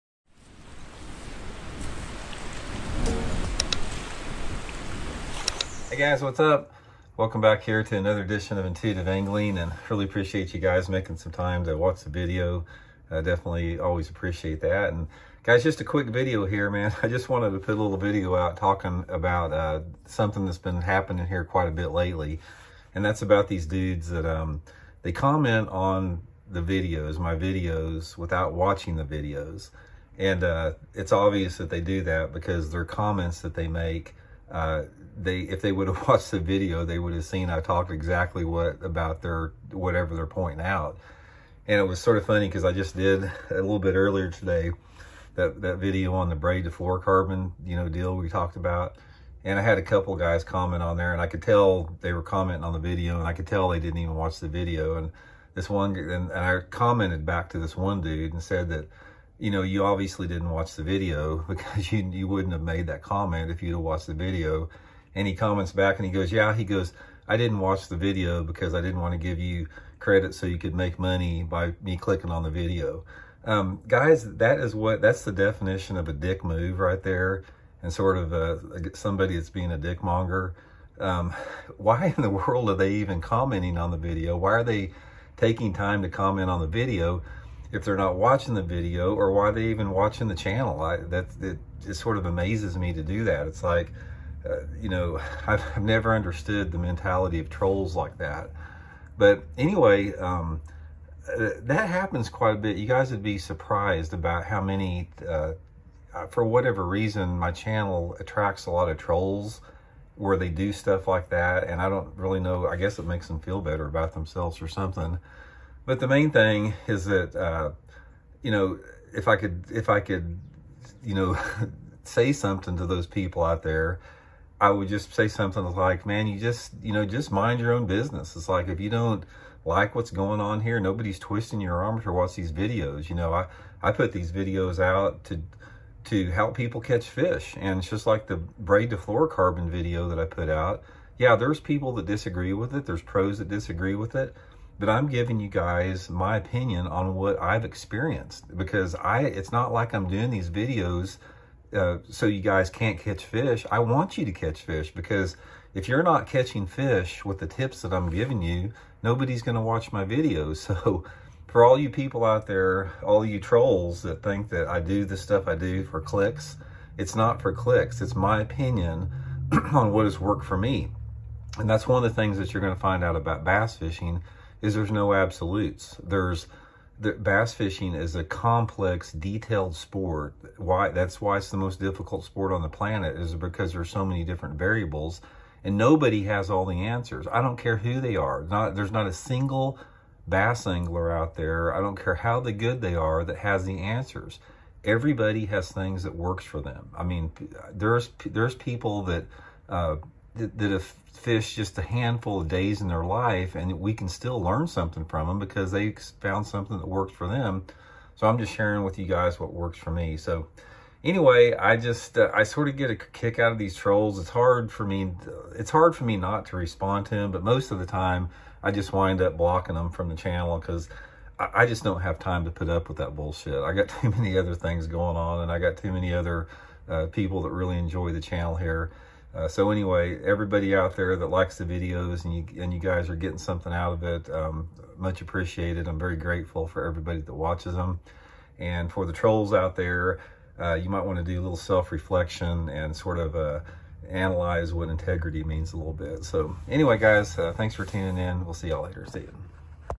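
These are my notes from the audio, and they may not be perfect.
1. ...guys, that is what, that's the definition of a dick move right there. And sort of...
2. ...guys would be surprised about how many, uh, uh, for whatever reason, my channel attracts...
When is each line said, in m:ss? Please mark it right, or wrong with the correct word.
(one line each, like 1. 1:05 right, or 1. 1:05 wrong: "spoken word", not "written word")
1. 1:13 right
2. 1:42 right.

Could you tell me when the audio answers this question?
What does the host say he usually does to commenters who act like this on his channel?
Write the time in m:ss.
3:39.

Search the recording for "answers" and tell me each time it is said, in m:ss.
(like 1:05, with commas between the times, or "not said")
3:06, 3:13.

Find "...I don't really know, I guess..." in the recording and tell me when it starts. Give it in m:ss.
1:51.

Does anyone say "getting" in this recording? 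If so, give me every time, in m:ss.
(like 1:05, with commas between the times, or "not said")
3:53.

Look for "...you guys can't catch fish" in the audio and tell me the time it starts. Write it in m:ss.
2:32.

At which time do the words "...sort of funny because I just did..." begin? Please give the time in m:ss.
0:41.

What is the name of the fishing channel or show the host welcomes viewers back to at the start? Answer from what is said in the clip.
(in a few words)
Intuitive Angling.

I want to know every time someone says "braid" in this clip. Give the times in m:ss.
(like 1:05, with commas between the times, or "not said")
0:46, 2:18.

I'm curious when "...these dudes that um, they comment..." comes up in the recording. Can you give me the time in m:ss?
0:23.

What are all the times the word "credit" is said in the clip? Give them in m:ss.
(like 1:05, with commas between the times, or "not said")
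1:09.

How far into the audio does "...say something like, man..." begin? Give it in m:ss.
2:05.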